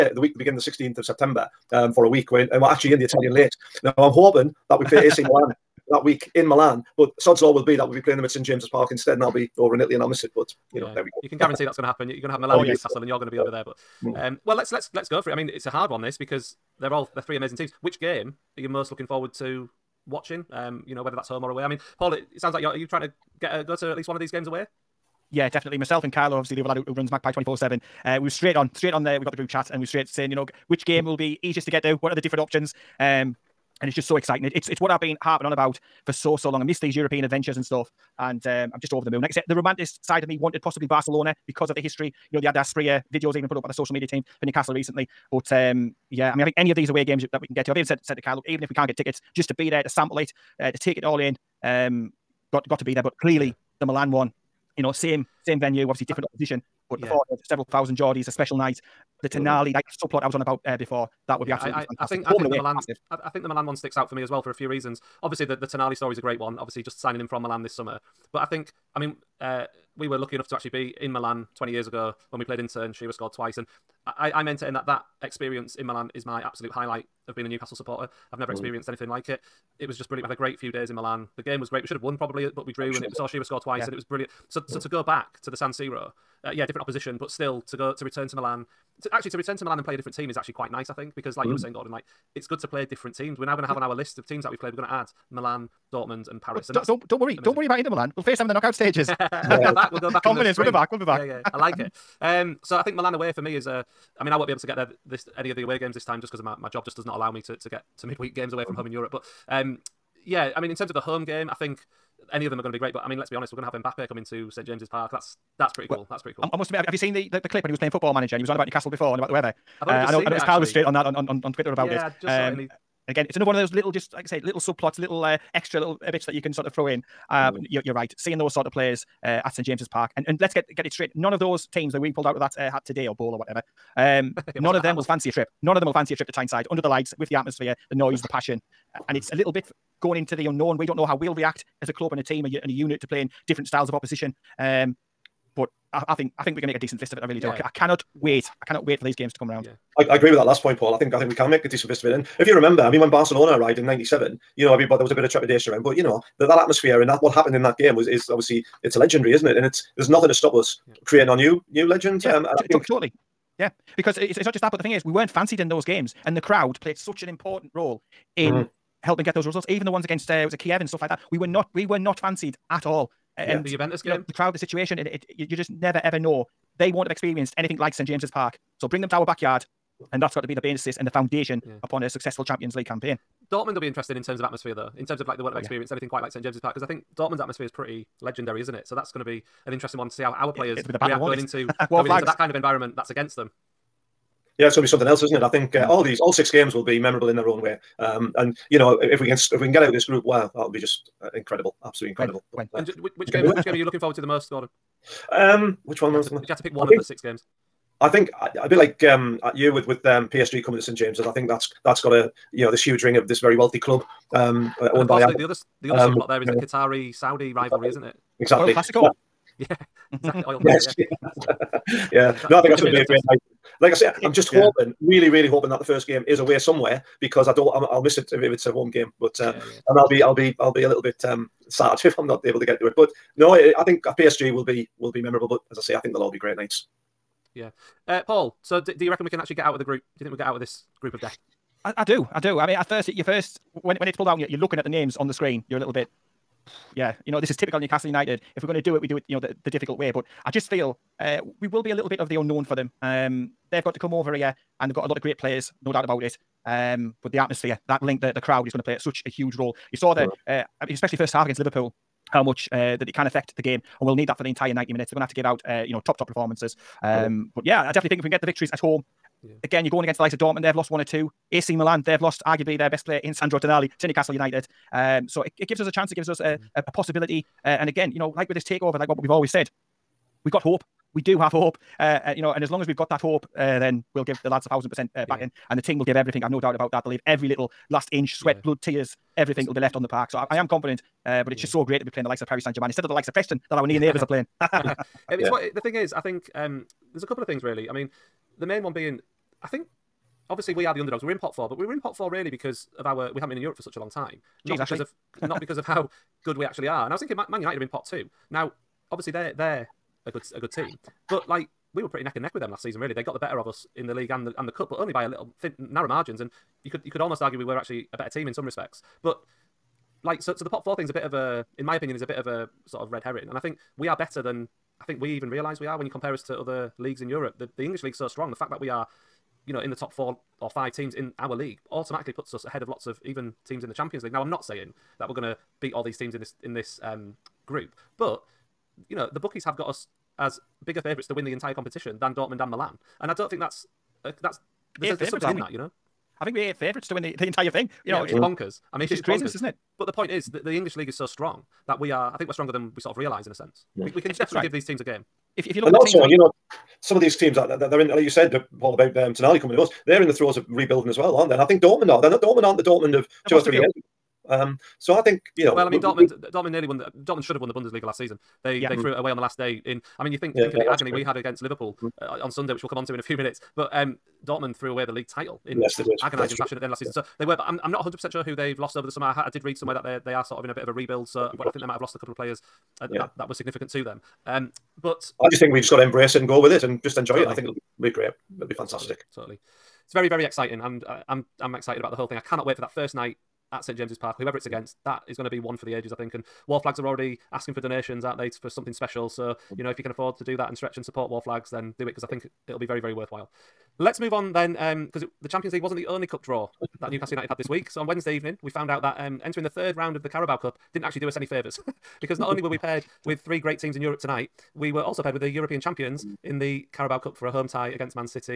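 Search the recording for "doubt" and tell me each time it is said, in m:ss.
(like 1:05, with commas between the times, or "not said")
4:15, 4:46.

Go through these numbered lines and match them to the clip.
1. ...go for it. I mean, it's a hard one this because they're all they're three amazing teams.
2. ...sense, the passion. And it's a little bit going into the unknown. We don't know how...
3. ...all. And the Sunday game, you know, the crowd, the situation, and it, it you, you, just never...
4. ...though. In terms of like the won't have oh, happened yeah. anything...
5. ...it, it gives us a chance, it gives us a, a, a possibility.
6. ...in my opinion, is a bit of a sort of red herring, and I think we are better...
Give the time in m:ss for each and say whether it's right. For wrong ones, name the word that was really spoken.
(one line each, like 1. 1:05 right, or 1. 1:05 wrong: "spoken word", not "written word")
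1. 0:15 right
2. 2:17 wrong: "noise", not "sense"
3. 2:52 wrong: "Juventus", not "Sunday"
4. 3:04 wrong: "experienced", not "happened"
5. 4:35 right
6. 5:21 right.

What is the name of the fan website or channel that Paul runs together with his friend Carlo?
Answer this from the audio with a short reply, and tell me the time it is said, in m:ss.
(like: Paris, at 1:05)
Magpie 24/7, at 0:27.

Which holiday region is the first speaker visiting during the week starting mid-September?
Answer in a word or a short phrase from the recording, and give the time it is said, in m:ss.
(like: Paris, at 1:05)
Italian Lakes, at 0:03.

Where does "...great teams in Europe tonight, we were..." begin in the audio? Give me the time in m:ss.
6:53.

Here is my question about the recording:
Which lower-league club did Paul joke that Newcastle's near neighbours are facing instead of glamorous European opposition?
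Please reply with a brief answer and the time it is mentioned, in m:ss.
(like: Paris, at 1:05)
Preston, at 4:53.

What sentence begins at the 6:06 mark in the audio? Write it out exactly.
The, Dortmund should have won the Bundesliga last season.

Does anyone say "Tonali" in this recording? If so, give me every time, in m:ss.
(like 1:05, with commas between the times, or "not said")
4:33, 5:59.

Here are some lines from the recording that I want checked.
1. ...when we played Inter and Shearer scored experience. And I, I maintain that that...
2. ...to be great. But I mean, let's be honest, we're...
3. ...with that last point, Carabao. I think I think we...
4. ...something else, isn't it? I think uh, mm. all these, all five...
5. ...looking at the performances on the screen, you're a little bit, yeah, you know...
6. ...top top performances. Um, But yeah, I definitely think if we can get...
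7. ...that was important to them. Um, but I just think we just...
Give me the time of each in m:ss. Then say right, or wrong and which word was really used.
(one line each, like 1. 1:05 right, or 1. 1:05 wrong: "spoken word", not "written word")
1. 1:12 wrong: "twice", not "experience"
2. 1:52 right
3. 2:30 wrong: "Paul", not "Carabao"
4. 3:14 wrong: "six", not "five"
5. 4:04 wrong: "names", not "performances"
6. 4:26 right
7. 6:23 wrong: "significant", not "important".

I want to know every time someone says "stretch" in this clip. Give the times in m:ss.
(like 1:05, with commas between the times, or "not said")
6:40.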